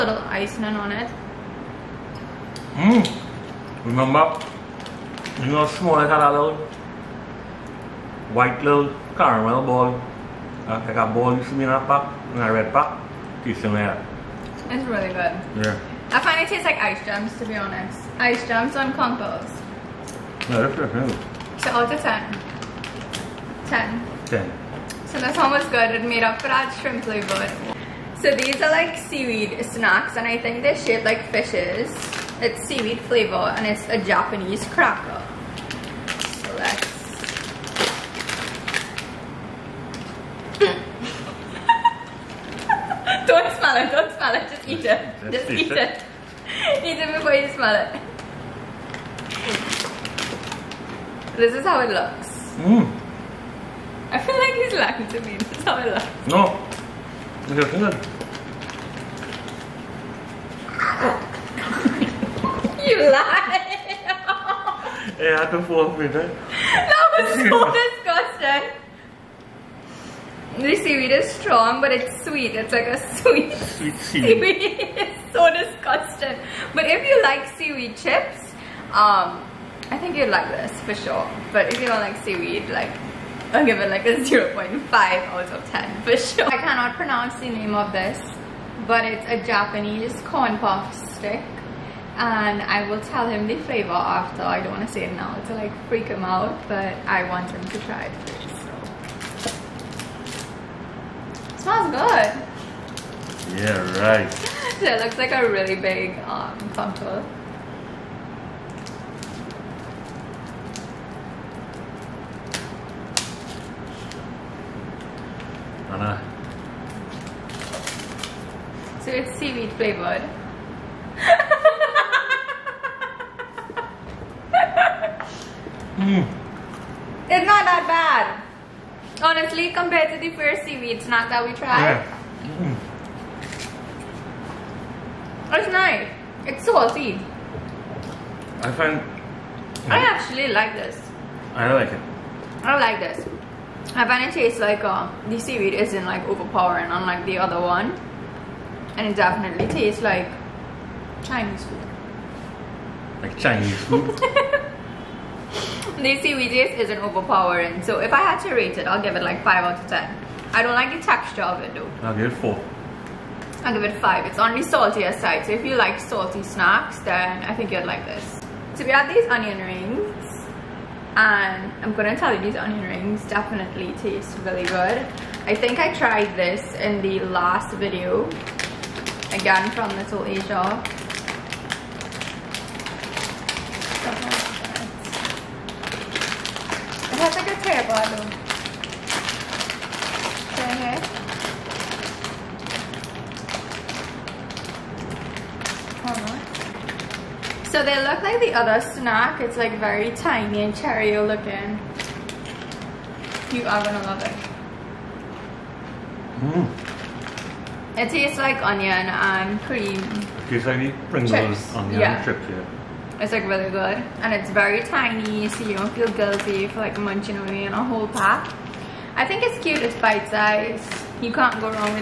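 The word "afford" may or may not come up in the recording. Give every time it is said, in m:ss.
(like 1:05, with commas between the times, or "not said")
not said.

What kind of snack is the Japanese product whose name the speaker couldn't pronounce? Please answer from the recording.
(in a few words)
Corn puff stick.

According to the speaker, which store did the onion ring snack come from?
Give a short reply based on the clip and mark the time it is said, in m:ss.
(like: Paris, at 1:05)
Little Asia, at 2:59.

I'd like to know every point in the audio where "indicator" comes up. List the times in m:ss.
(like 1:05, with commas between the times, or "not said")
not said.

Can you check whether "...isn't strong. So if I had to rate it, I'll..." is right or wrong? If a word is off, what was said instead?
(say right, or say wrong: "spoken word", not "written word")
wrong: "overpowering", not "strong".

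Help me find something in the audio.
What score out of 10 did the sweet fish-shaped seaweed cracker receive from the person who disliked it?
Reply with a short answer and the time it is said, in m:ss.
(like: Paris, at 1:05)
0.5, at 1:24.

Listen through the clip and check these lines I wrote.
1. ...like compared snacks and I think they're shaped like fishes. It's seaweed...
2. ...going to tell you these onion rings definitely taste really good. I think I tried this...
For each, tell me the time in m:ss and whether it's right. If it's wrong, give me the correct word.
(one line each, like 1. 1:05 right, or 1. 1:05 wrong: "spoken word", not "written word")
1. 0:28 wrong: "seaweed", not "compared"
2. 2:51 right.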